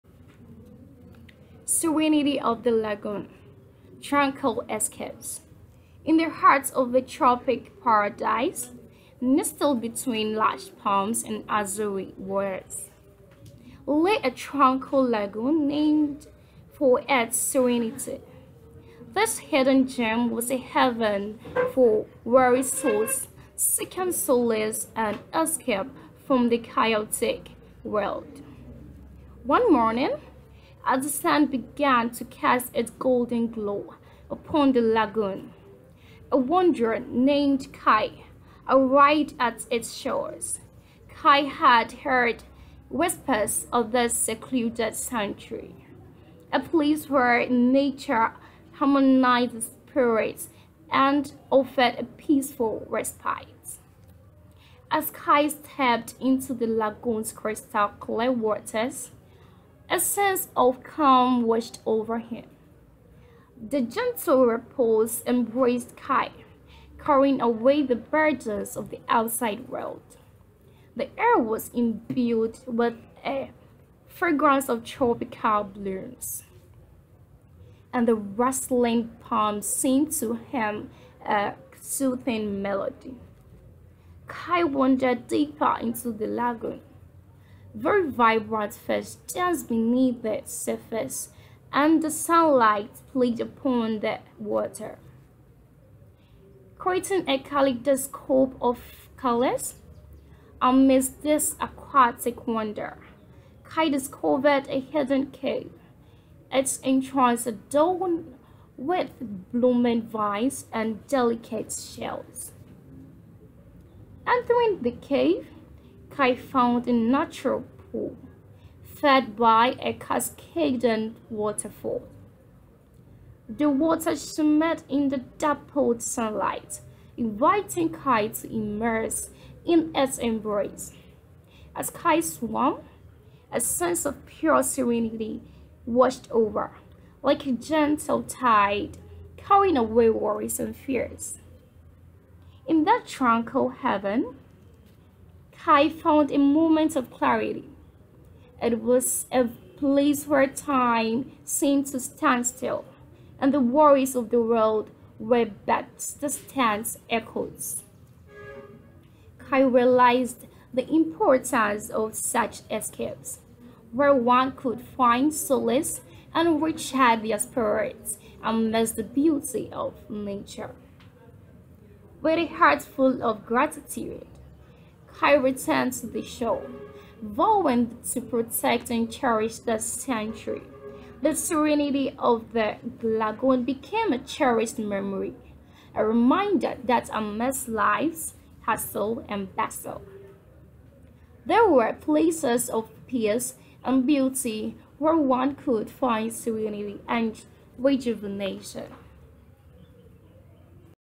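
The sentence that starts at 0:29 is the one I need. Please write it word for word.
One morning, as the sun began to cast its golden glow upon the lagoon.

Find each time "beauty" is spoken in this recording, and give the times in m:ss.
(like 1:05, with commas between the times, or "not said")
2:49, 3:14.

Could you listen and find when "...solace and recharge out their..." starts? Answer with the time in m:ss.
2:45.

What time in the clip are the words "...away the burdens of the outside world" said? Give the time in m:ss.
1:07.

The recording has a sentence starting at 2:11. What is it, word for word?
As Kai swam, a sense of pure serenity washed over, like a gentle tide carrying away worries and fears.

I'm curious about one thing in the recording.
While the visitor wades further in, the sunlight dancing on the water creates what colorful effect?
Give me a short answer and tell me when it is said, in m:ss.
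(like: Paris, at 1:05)
a kaleidoscope of colors, at 1:37.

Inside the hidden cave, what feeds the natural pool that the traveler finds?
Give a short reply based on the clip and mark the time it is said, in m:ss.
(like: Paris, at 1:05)
a cascading waterfall, at 1:59.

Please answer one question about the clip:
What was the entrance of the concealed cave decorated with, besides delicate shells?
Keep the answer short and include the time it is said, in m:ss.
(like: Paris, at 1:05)
blooming vines, at 1:49.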